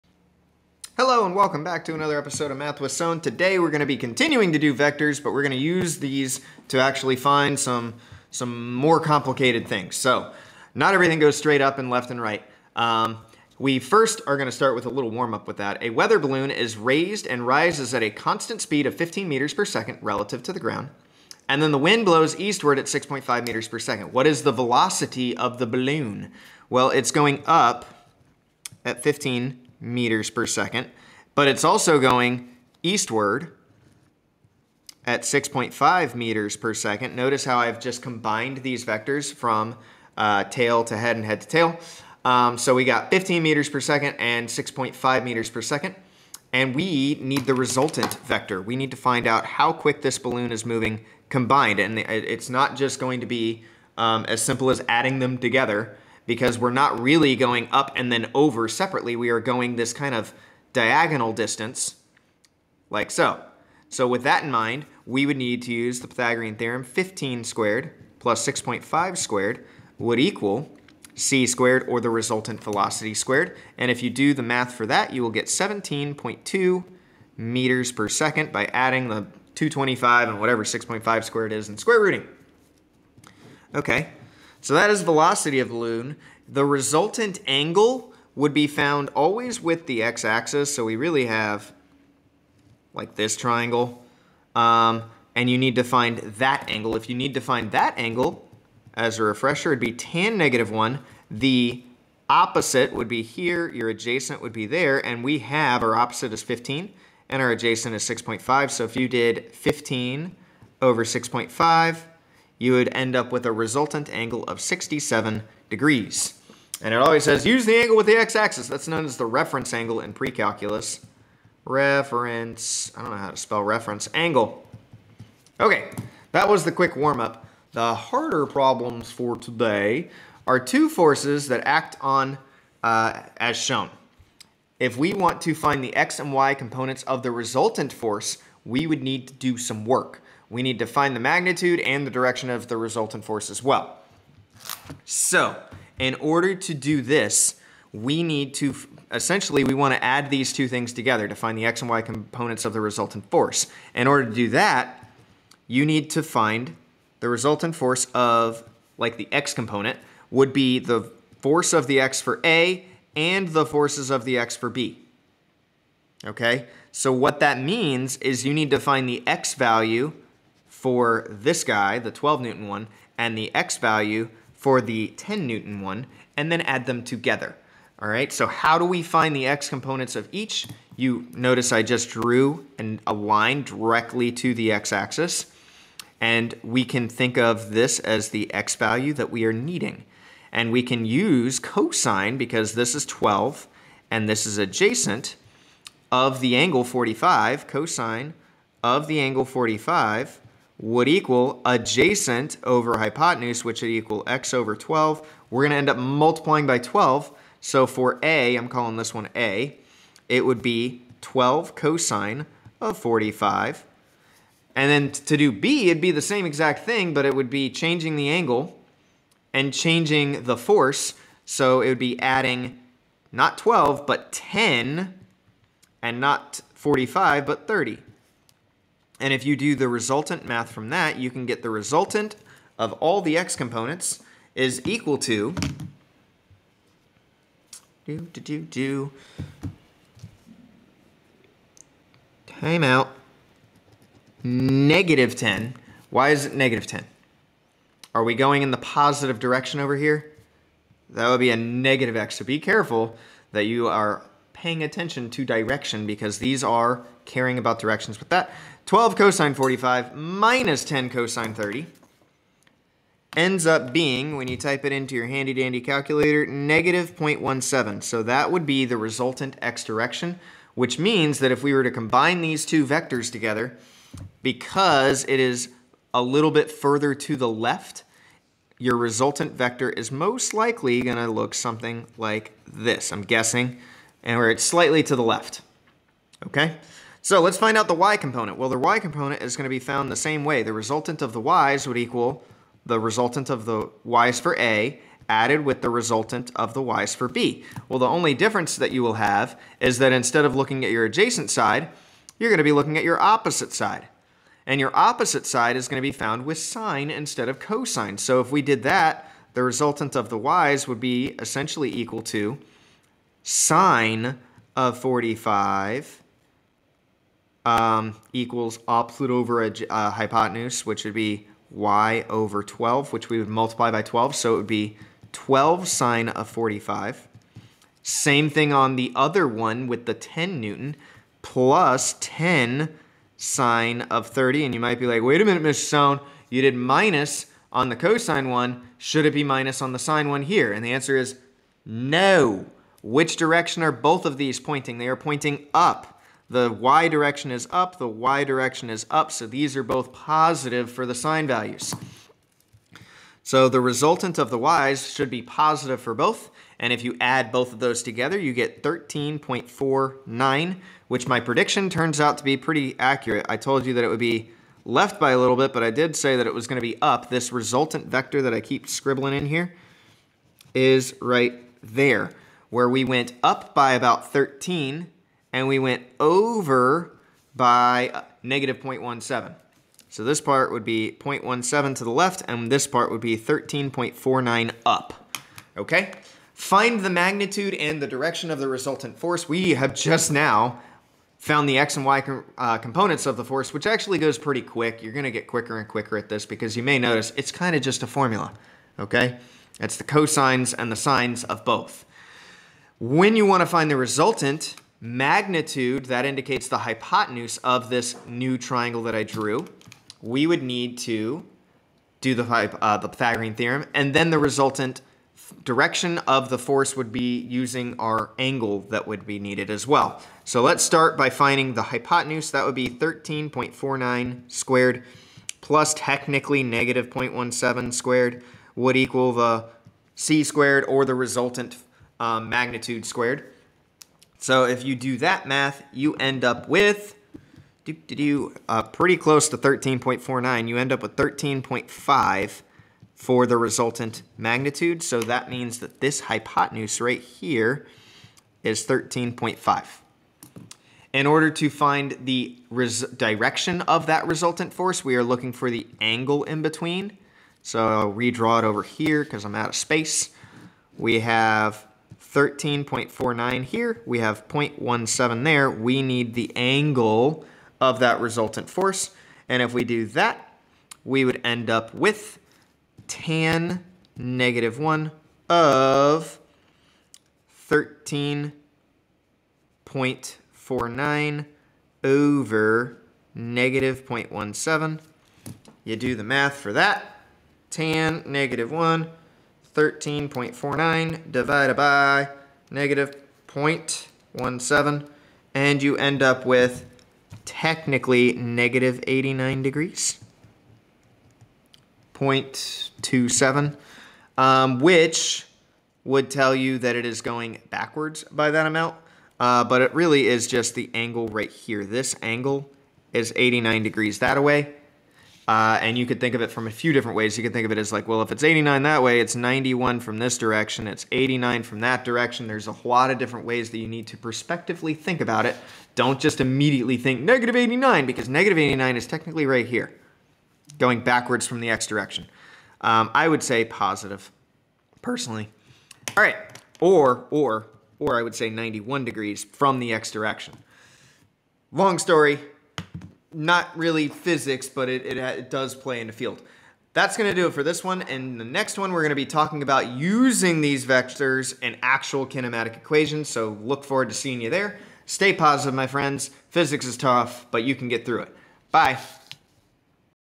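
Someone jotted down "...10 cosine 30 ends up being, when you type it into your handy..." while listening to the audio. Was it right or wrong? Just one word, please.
right.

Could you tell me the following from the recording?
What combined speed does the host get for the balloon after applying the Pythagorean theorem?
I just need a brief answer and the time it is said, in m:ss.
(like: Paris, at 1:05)
17.2 meters per second, at 1:15.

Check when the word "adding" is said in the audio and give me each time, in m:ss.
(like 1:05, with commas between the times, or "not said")
0:54, 1:18, 3:42.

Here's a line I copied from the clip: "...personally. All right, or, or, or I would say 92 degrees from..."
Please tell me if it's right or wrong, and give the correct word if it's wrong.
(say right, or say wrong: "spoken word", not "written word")
wrong: "91", not "92".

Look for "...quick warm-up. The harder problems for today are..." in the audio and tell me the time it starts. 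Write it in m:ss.
2:06.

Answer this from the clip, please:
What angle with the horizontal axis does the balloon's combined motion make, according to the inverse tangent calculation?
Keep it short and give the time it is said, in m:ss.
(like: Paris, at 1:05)
67 degrees, at 1:54.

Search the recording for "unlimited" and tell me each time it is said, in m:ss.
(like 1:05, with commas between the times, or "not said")
not said.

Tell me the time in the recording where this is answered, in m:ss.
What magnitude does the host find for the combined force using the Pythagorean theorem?
7:21.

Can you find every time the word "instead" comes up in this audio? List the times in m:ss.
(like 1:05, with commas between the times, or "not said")
5:00, 5:07.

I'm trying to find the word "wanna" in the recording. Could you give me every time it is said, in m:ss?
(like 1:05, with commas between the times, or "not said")
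2:29, 6:43.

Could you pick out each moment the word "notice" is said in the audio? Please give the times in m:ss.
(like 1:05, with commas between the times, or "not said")
0:37, 3:01, 6:36.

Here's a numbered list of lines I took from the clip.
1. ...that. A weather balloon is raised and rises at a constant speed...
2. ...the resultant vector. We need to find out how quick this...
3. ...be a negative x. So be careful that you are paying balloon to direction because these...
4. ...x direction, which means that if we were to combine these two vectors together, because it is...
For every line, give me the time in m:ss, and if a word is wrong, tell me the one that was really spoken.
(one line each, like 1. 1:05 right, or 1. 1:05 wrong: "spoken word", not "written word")
1. 0:15 right
2. 0:47 right
3. 4:11 wrong: "attention", not "balloon"
4. 4:29 right.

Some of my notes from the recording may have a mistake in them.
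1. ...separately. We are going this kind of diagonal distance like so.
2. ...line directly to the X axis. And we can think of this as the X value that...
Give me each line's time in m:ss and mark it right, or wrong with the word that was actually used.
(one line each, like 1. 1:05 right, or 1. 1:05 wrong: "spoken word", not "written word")
1. 0:58 right
2. 3:03 right.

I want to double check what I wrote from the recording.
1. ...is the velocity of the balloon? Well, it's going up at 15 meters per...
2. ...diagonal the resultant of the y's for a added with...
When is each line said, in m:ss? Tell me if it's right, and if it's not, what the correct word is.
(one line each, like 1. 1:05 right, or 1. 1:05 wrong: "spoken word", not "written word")
1. 0:24 right
2. 4:51 wrong: "equal", not "diagonal".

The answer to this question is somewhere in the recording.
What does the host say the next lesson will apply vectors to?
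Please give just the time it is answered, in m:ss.
9:12.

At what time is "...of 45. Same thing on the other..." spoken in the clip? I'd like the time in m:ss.
5:26.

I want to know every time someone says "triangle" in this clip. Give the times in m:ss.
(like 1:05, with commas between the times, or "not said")
1:33, 6:48.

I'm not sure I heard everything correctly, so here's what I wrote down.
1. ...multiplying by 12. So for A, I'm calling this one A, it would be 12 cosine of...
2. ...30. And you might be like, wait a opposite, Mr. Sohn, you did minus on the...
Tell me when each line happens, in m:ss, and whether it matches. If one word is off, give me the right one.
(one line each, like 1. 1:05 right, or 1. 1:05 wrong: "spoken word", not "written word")
1. 3:25 right
2. 5:34 wrong: "minute", not "opposite".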